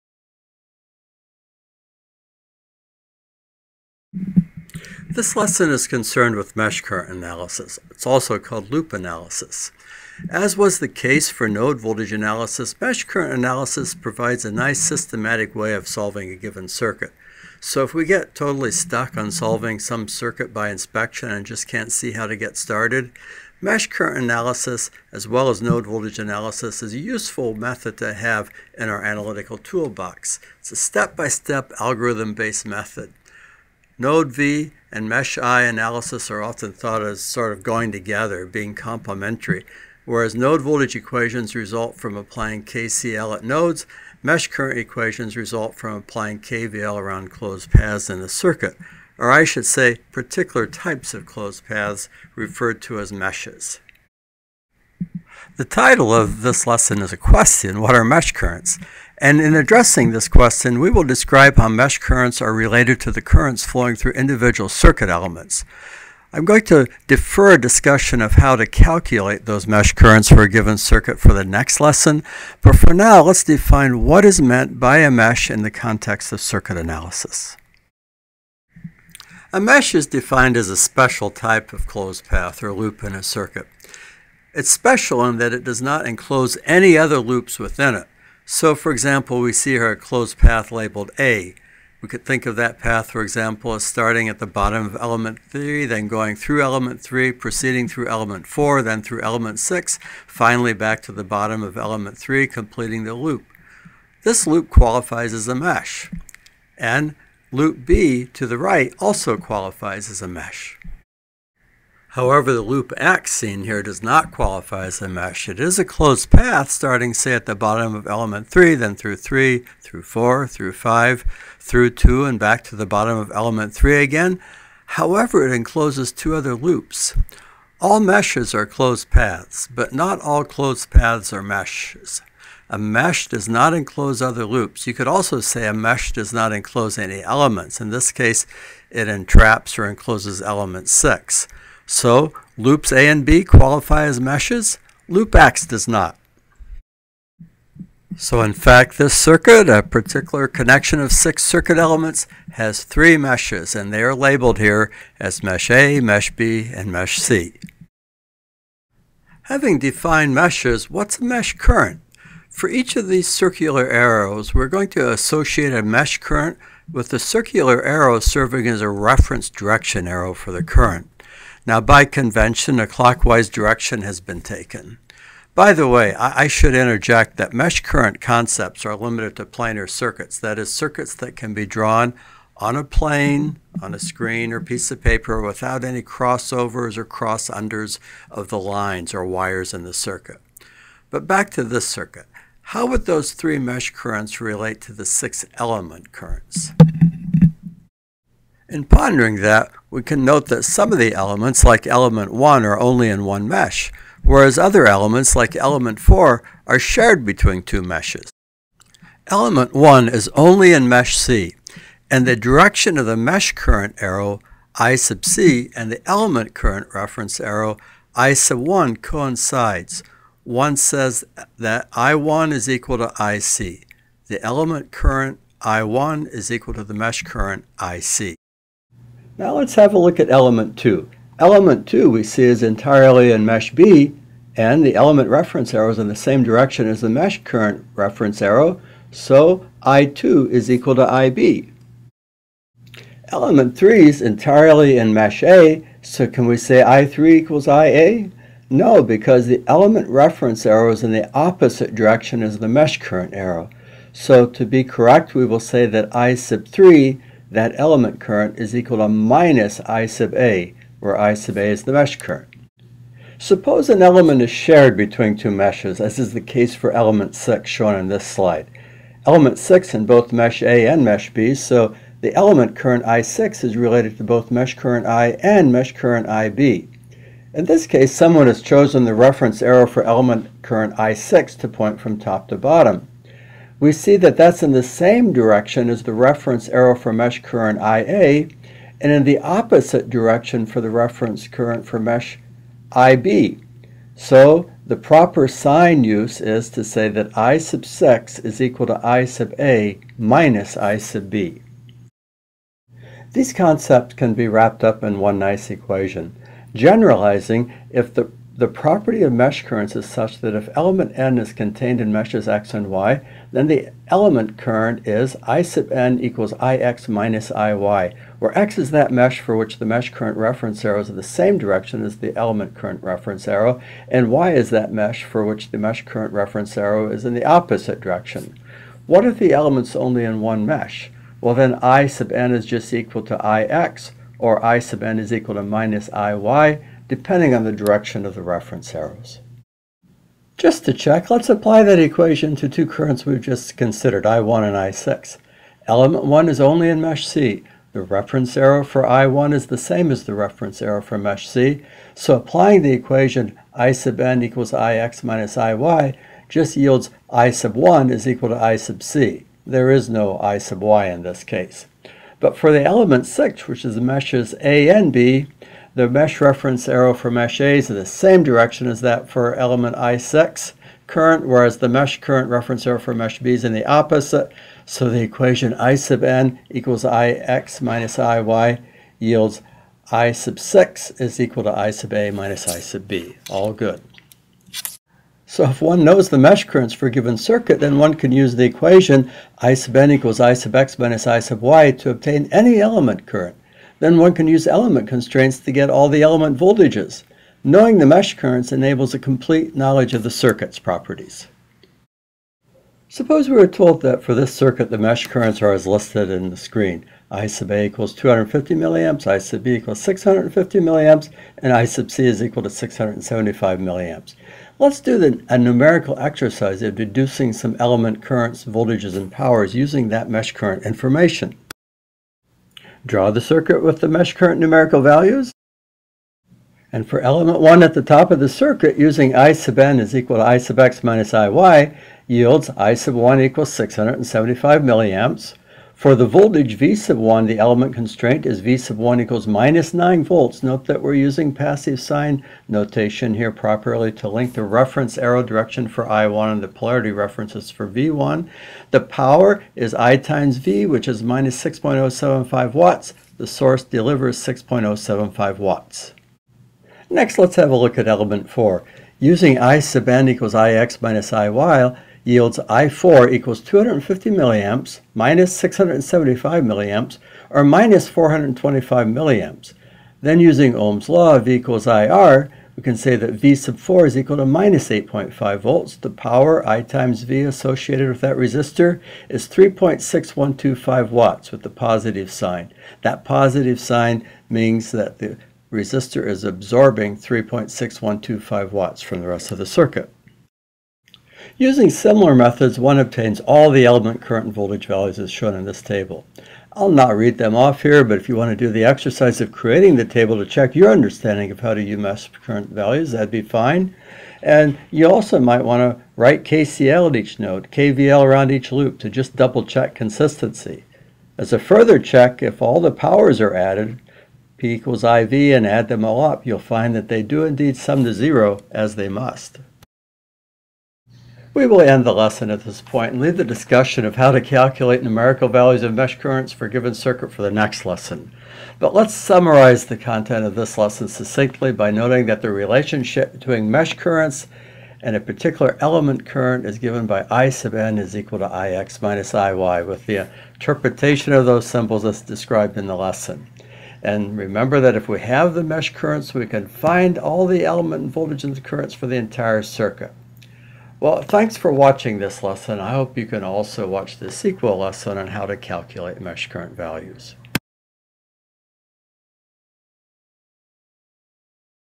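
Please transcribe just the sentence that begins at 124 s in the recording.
However, it encloses two other loops.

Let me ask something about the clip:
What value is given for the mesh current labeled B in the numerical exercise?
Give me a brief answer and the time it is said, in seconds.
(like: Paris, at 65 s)
650 milliamps, at 410 s.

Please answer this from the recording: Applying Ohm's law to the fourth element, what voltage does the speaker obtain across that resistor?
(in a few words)
-8.5 volts.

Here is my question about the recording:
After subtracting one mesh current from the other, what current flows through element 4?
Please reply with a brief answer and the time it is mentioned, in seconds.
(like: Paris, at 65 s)
-425 milliamps, at 467 s.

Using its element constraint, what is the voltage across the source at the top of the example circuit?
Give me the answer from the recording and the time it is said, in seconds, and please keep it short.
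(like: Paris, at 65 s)
-9 volts, at 439 s.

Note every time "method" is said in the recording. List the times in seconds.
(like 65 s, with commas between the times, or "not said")
27 s, 32 s, 492 s.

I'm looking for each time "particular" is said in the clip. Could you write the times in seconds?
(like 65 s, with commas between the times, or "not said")
50 s, 149 s, 535 s.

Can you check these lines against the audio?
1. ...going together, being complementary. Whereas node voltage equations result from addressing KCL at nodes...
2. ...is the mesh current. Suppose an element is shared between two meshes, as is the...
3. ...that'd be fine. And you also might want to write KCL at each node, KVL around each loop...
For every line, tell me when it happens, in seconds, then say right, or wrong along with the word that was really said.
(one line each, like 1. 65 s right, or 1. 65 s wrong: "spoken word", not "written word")
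1. 37 s wrong: "applying", not "addressing"
2. 261 s right
3. 503 s right.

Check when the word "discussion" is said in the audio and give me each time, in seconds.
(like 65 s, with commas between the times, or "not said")
67 s, 523 s.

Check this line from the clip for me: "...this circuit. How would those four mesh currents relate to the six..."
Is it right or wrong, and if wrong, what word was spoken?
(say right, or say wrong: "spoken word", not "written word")
wrong: "three", not "four".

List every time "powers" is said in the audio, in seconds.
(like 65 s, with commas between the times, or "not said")
419 s, 449 s, 476 s, 512 s.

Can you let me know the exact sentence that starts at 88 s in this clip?
So, for example, we see here a closed path labeled A.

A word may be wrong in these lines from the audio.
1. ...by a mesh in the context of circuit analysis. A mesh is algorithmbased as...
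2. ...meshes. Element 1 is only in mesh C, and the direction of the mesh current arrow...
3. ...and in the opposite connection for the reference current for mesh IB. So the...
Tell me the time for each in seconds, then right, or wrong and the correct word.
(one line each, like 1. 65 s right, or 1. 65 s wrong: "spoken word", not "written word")
1. 74 s wrong: "defined", not "algorithmbased"
2. 207 s right
3. 289 s wrong: "direction", not "connection".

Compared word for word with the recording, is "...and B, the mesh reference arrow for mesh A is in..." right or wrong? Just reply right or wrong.
right.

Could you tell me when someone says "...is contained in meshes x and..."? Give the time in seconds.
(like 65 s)
311 s.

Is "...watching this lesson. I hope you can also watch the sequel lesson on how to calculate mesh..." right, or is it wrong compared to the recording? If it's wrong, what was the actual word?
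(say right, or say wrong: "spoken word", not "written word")
right.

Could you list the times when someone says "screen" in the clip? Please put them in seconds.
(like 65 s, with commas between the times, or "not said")
183 s, 406 s.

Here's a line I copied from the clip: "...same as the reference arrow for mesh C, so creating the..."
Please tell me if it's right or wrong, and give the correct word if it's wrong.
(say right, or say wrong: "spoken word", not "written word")
wrong: "applying", not "creating".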